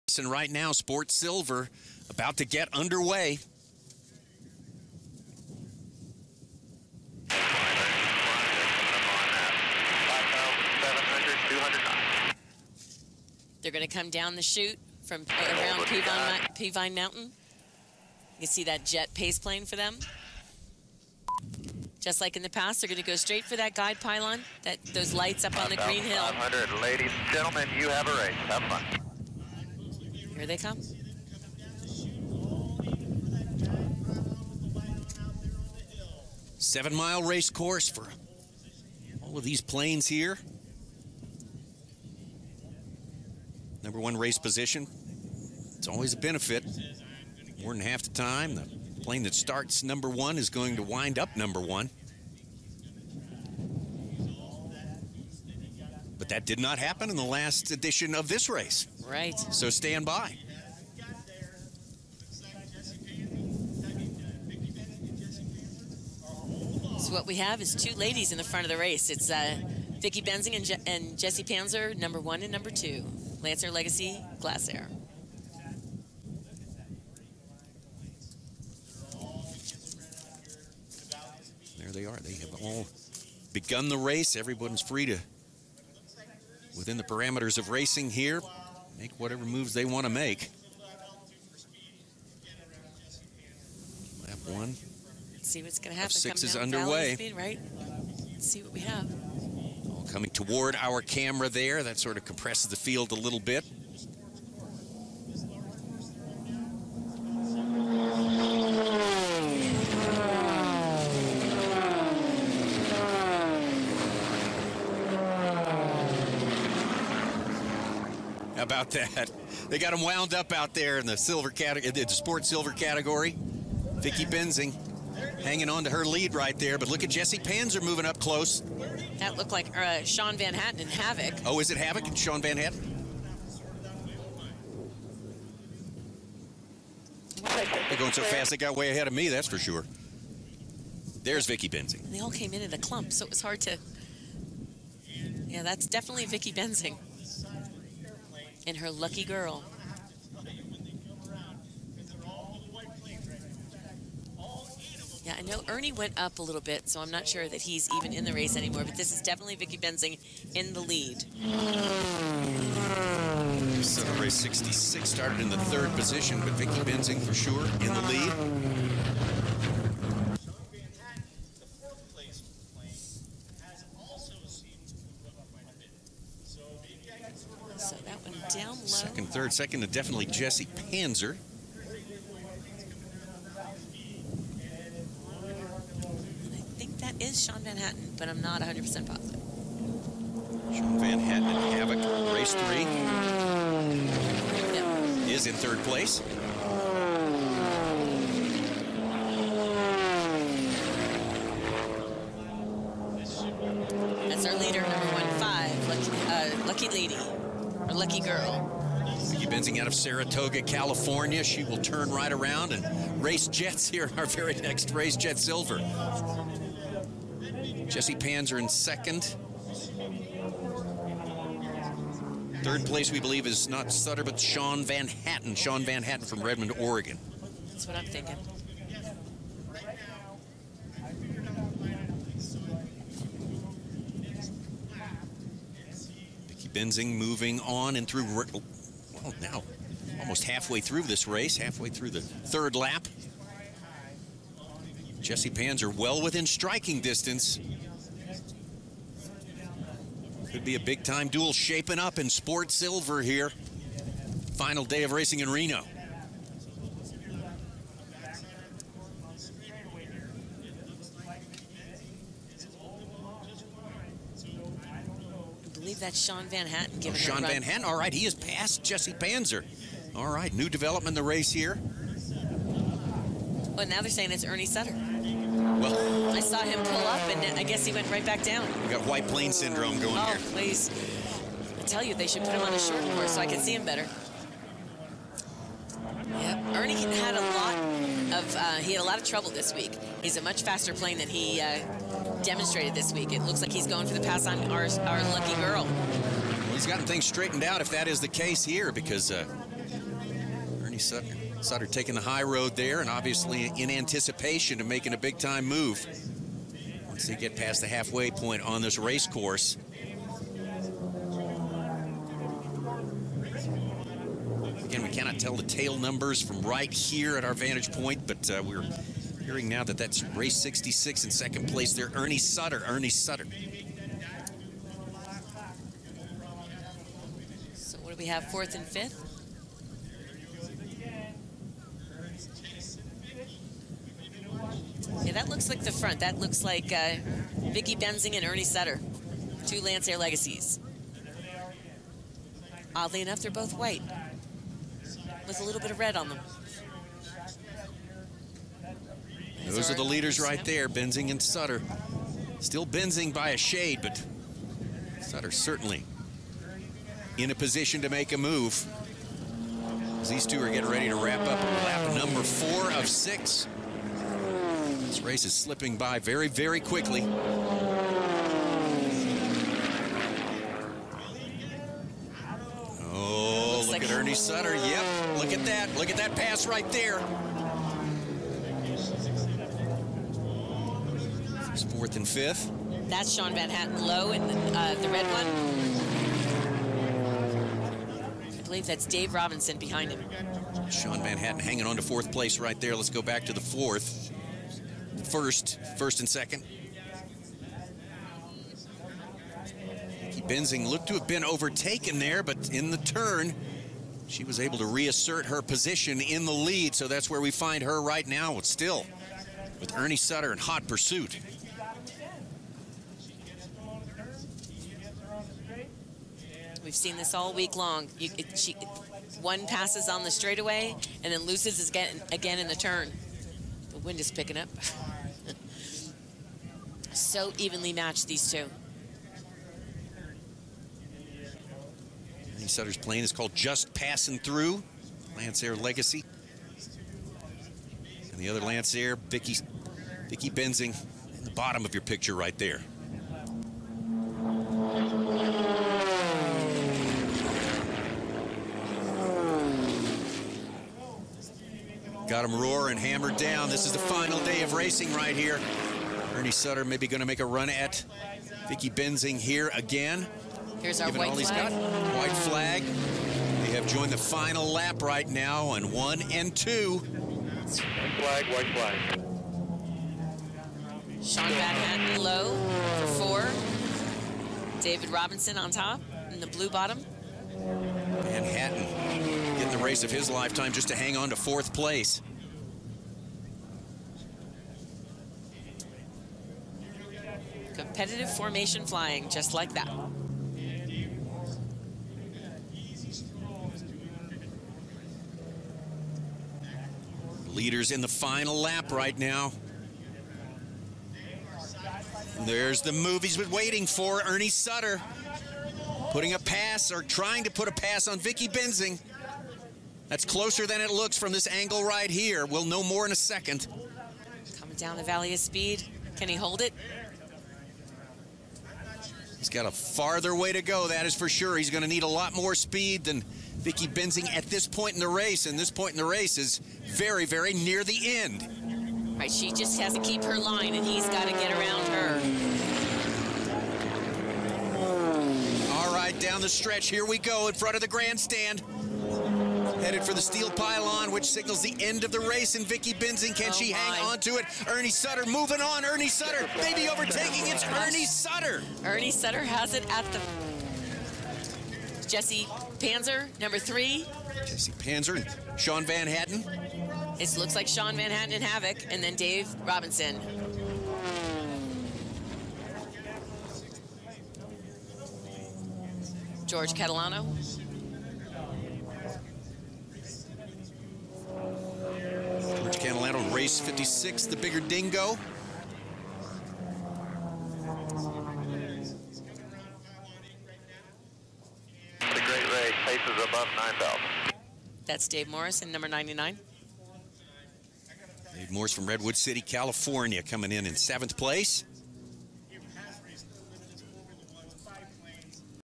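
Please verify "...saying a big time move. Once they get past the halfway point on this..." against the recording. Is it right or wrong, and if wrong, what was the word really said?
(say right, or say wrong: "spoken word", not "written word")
wrong: "making", not "saying".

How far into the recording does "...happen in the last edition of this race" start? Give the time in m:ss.
0:56.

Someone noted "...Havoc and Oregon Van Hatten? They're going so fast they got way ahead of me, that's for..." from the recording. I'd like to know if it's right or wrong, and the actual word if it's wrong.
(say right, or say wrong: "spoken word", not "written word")
wrong: "Sean", not "Oregon".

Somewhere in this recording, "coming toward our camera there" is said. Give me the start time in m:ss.
1:40.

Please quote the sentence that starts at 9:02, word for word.
And Vicky Benzing, can oh she my.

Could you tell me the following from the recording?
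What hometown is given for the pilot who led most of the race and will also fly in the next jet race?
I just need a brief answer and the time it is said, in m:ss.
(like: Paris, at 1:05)
Saratoga, California, at 3:29.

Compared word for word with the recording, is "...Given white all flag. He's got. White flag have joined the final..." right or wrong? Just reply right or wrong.
right.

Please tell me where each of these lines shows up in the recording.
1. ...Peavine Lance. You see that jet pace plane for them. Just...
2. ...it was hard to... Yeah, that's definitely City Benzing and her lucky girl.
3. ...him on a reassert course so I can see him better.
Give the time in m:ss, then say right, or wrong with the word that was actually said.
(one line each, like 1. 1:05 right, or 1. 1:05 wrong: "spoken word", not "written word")
1. 0:16 wrong: "Mountain", not "Lance"
2. 2:23 wrong: "Vicky", not "City"
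3. 4:42 wrong: "short", not "reassert".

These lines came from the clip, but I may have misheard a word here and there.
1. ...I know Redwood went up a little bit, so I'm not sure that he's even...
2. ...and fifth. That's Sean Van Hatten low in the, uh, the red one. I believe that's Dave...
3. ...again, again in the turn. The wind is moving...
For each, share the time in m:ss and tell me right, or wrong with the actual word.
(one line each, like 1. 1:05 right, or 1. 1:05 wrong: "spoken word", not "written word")
1. 2:35 wrong: "Ernie", not "Redwood"
2. 6:22 right
3. 7:01 wrong: "picking", not "moving".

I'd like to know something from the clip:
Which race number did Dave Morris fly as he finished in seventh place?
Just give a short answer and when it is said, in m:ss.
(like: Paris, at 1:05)
99, at 9:45.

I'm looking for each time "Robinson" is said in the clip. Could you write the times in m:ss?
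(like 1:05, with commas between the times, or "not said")
6:29, 7:55, 9:19.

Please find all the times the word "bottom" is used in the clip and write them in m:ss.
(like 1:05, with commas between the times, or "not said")
7:21, 7:56.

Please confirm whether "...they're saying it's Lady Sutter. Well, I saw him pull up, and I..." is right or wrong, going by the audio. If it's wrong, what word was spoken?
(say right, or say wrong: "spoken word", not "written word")
wrong: "Ernie", not "Lady".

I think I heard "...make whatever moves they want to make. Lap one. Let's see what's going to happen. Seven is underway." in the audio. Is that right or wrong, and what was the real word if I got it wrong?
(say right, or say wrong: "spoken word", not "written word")
wrong: "Six", not "Seven".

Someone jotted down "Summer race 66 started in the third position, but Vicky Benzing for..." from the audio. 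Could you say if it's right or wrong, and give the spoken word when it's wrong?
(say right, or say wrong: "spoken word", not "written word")
right.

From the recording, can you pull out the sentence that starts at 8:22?
There's the move he's been waiting for.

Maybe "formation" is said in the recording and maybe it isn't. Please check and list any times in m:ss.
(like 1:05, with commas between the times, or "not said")
8:08.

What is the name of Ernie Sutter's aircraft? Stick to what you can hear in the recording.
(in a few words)
Just Passing Through.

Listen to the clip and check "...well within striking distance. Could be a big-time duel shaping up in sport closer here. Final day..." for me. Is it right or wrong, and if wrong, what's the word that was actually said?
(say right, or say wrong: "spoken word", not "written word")
wrong: "silver", not "closer".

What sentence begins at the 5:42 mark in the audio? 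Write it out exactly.
Oddly enough, they're both white with a little bit of red on them.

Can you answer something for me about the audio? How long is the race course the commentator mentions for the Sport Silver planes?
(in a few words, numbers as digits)
7 miles.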